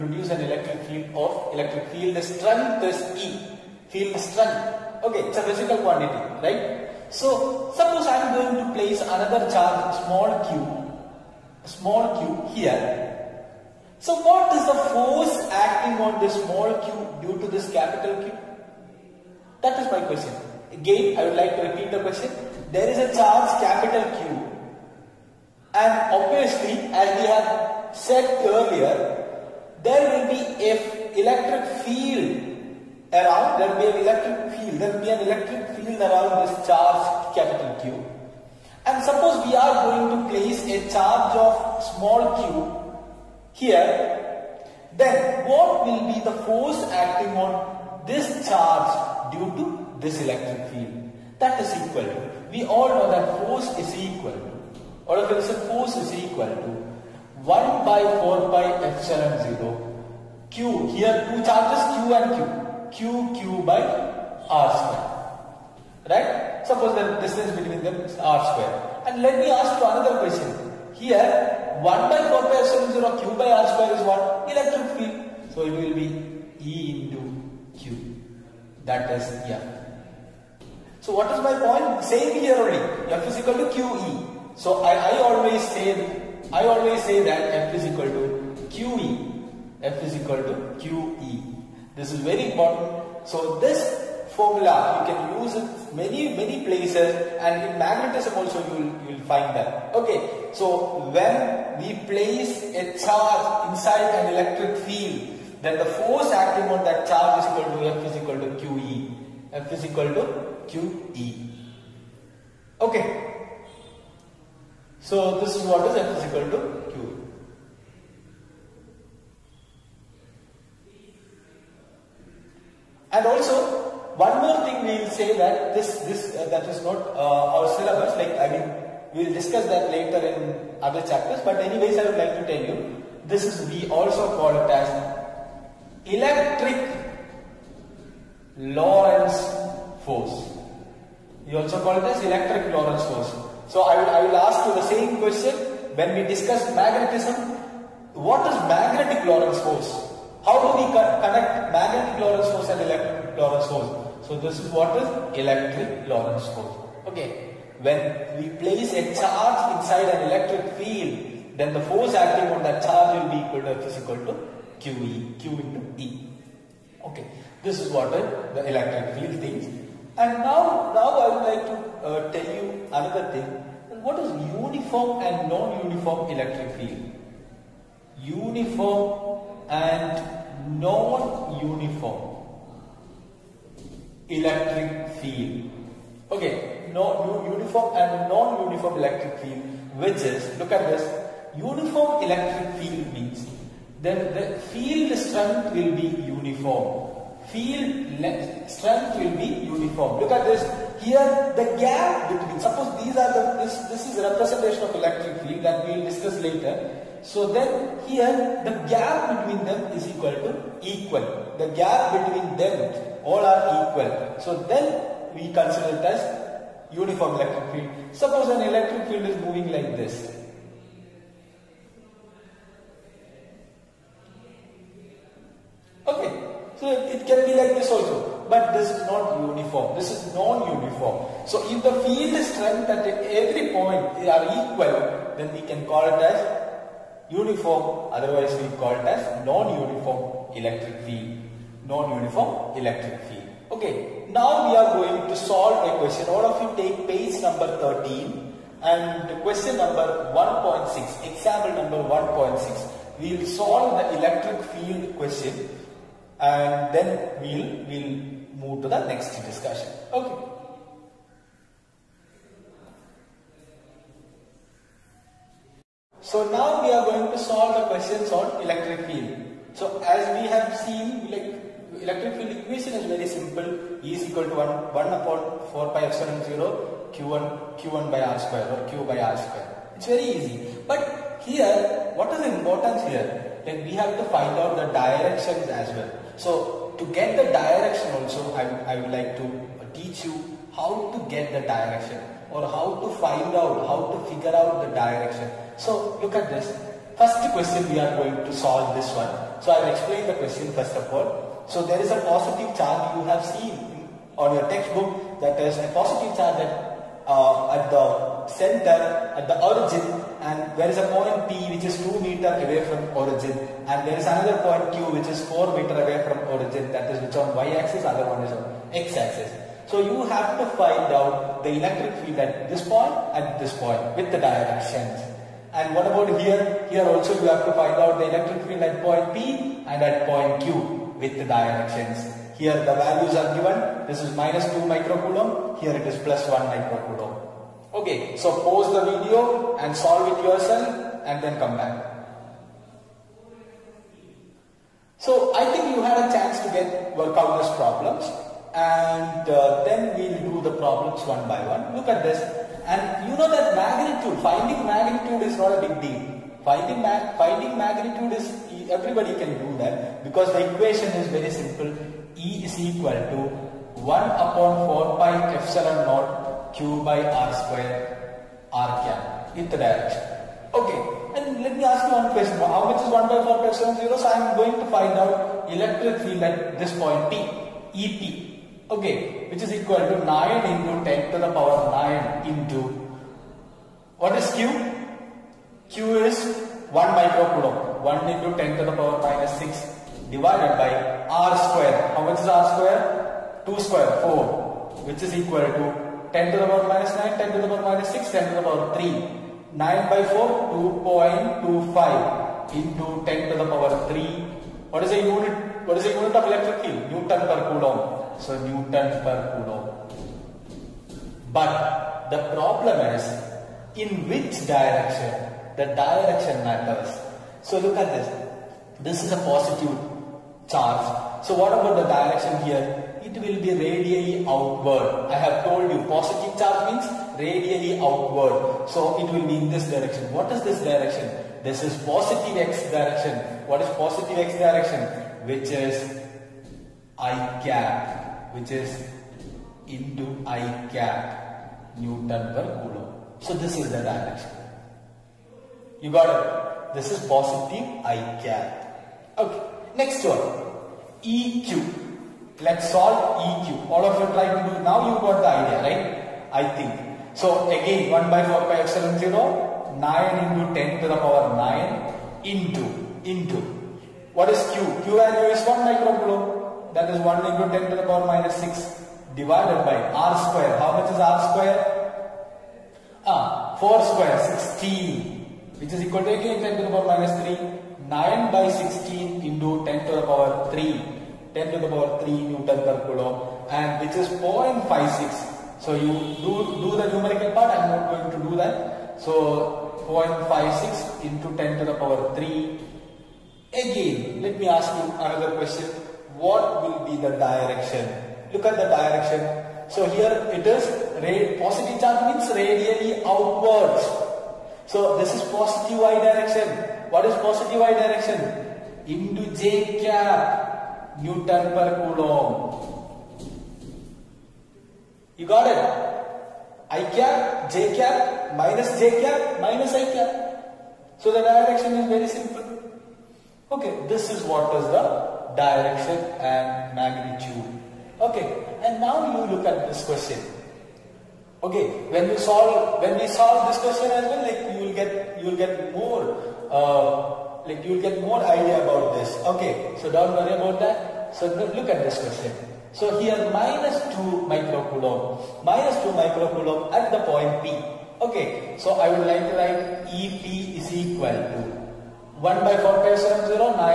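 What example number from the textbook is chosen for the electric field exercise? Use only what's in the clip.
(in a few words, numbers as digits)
1.6.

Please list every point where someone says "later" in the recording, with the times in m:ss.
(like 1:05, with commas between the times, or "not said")
2:09, 3:26.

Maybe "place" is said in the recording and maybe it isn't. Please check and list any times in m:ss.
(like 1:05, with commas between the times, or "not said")
0:08, 0:40, 1:36, 1:42, 2:38.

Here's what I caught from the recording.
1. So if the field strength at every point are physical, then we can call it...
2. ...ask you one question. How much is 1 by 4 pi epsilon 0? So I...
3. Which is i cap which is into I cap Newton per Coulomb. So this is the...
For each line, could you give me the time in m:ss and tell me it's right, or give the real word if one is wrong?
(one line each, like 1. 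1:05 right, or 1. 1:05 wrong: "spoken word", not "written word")
1. 3:51 wrong: "equal", not "physical"
2. 6:11 right
3. 7:15 right.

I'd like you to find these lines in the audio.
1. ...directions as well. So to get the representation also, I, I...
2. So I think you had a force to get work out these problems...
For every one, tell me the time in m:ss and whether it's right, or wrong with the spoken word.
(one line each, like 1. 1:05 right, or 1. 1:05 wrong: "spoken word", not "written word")
1. 4:44 wrong: "direction", not "representation"
2. 5:45 wrong: "chance", not "force".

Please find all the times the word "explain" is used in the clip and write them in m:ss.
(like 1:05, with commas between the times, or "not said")
4:59.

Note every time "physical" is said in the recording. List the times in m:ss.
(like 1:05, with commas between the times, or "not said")
0:05.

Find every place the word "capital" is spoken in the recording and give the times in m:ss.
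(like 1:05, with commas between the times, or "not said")
0:17, 0:23, 0:37.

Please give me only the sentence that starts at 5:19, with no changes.
So you have to find out the electric field at this point at this point with the directions.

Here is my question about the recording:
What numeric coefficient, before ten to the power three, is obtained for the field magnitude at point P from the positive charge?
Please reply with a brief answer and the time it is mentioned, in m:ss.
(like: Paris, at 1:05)
2.25, at 6:41.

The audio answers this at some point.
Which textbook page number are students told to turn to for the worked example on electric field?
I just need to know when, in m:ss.
4:07.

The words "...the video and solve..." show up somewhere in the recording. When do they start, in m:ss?
5:38.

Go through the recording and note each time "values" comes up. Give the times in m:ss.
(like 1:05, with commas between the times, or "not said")
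5:32, 7:45.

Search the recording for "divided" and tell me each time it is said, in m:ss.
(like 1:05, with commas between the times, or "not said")
6:30, 7:49.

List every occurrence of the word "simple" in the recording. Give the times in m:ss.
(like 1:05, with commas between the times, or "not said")
4:33, 6:01, 8:42.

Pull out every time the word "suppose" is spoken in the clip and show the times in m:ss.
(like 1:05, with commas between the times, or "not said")
0:07, 0:39, 1:06, 3:22, 3:38.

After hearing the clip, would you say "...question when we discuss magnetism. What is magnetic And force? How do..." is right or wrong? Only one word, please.
wrong.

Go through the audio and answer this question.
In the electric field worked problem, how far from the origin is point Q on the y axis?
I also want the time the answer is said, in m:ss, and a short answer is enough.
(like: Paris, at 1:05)
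4 meters, at 5:15.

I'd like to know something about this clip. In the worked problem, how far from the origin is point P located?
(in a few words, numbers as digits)
2 meters.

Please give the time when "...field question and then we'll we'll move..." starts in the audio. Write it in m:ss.
4:14.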